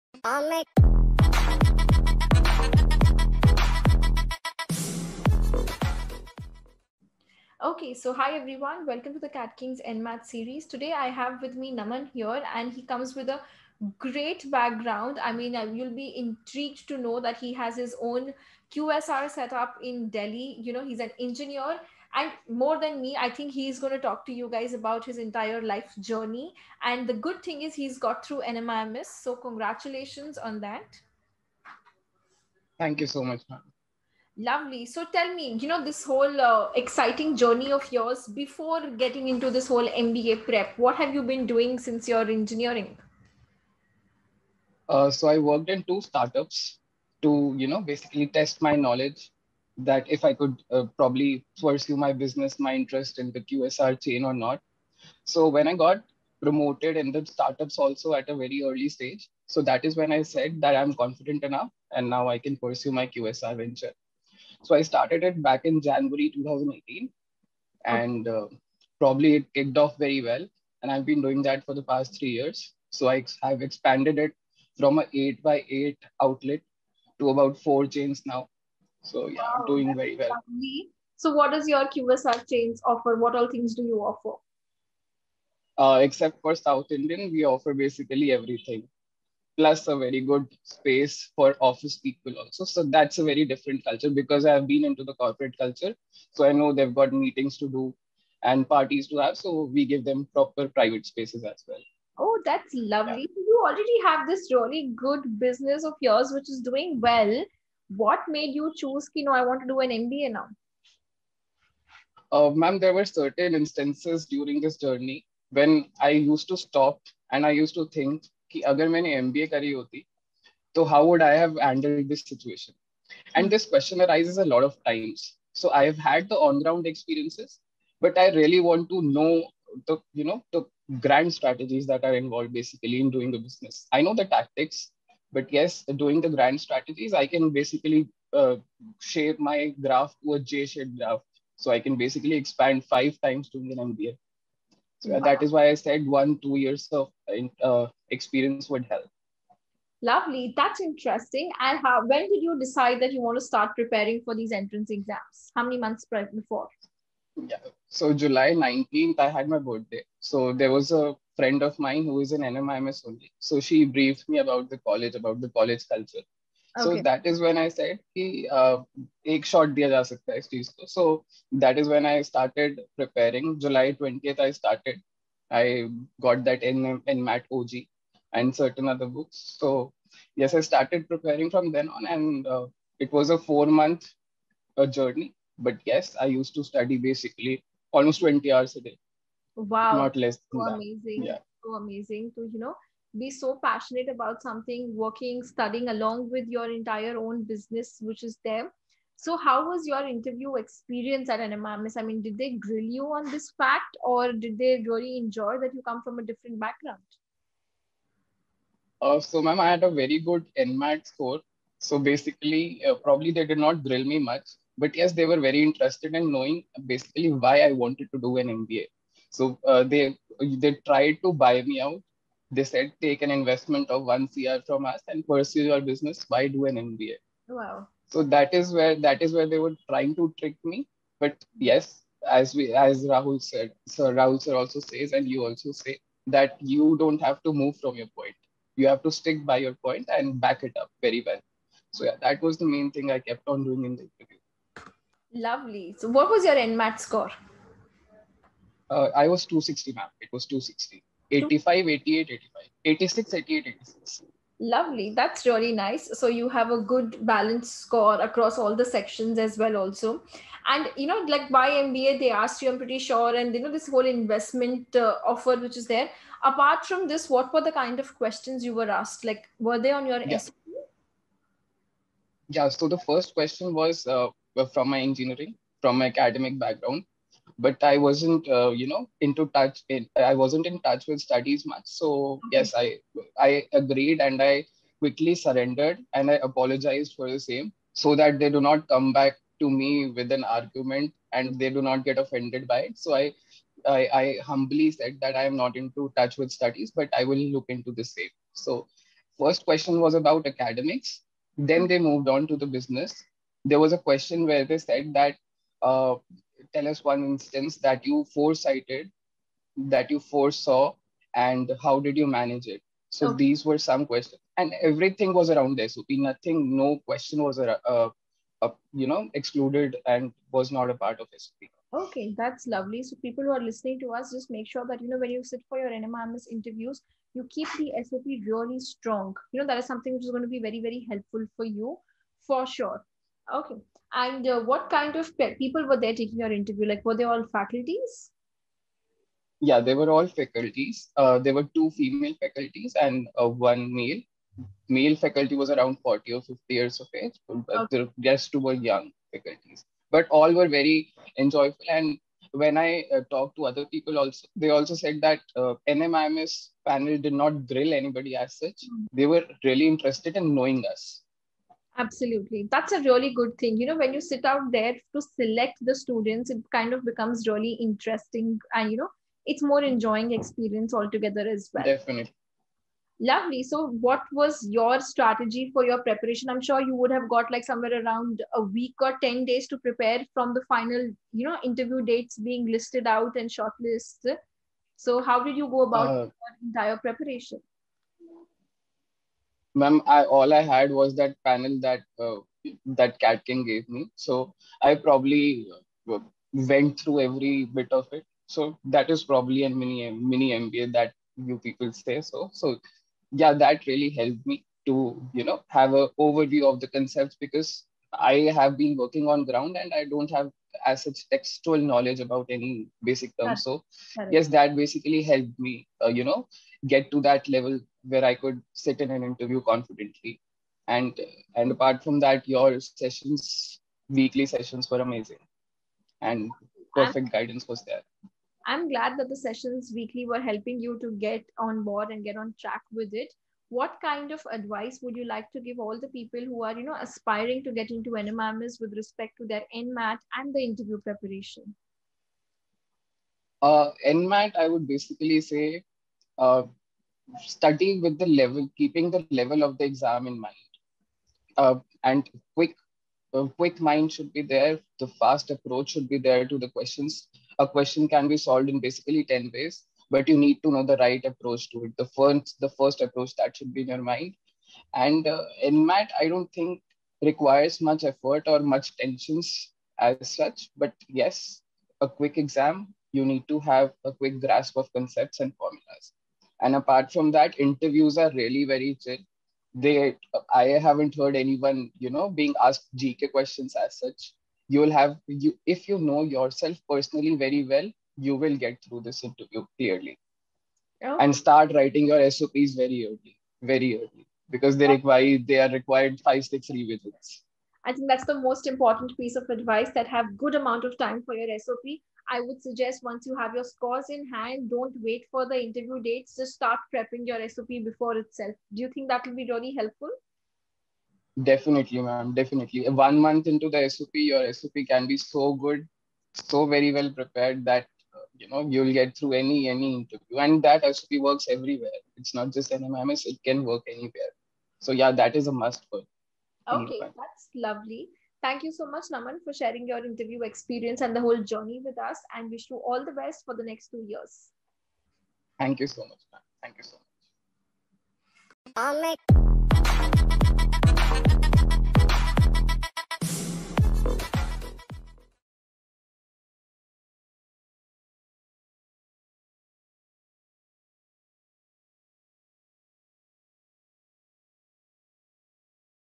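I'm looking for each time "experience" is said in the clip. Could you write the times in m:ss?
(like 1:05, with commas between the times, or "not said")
2:06, 2:28, 3:20, 6:10, 8:50.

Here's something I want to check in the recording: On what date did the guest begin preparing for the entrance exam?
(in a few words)
July 20.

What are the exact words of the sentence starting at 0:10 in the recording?
Today I have with me Naman here and he comes with a great background.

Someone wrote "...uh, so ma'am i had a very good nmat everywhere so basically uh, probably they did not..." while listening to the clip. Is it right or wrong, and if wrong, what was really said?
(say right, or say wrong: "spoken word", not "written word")
wrong: "score", not "everywhere".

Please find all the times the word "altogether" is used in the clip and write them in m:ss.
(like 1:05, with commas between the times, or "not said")
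6:11.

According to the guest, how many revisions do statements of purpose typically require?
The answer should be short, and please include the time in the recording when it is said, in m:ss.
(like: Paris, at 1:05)
5-6, at 8:16.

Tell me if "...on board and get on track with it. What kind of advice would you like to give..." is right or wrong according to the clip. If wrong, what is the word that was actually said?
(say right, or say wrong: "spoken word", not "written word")
right.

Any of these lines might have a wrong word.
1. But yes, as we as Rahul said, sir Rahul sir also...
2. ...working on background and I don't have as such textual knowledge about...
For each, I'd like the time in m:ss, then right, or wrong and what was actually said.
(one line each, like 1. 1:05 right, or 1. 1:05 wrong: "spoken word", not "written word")
1. 3:51 right
2. 6:48 wrong: "ground", not "background".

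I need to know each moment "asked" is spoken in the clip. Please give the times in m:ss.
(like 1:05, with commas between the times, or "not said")
4:22, 4:28, 8:02.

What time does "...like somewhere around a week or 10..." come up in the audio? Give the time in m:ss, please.
6:17.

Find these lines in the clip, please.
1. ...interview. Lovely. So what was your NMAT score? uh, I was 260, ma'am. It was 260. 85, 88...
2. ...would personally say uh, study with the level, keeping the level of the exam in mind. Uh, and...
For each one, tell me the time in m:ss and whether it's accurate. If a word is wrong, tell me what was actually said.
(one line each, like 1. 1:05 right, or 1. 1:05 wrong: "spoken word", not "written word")
1. 4:04 right
2. 7:24 wrong: "basically", not "personally".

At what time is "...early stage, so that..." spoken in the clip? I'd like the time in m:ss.
0:58.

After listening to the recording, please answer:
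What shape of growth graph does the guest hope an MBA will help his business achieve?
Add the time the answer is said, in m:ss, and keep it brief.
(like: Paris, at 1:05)
J-shaped, at 2:20.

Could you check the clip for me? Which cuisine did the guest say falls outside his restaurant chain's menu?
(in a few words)
South Indian.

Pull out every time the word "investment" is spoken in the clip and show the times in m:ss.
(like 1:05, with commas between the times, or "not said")
3:43, 4:24.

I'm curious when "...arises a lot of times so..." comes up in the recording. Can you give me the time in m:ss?
2:04.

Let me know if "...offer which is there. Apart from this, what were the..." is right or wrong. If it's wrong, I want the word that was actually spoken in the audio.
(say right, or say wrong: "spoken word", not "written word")
right.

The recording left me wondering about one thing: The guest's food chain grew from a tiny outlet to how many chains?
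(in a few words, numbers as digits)
4.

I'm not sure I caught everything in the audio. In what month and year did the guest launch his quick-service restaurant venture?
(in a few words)
January 2018.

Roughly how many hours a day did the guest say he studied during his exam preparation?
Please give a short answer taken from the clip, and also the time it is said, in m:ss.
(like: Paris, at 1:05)
20 hours, at 3:08.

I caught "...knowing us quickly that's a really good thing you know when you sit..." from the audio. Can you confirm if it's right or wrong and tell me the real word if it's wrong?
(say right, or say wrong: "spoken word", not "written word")
wrong: "absolutely", not "quickly".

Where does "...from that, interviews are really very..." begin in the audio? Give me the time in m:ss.
7:57.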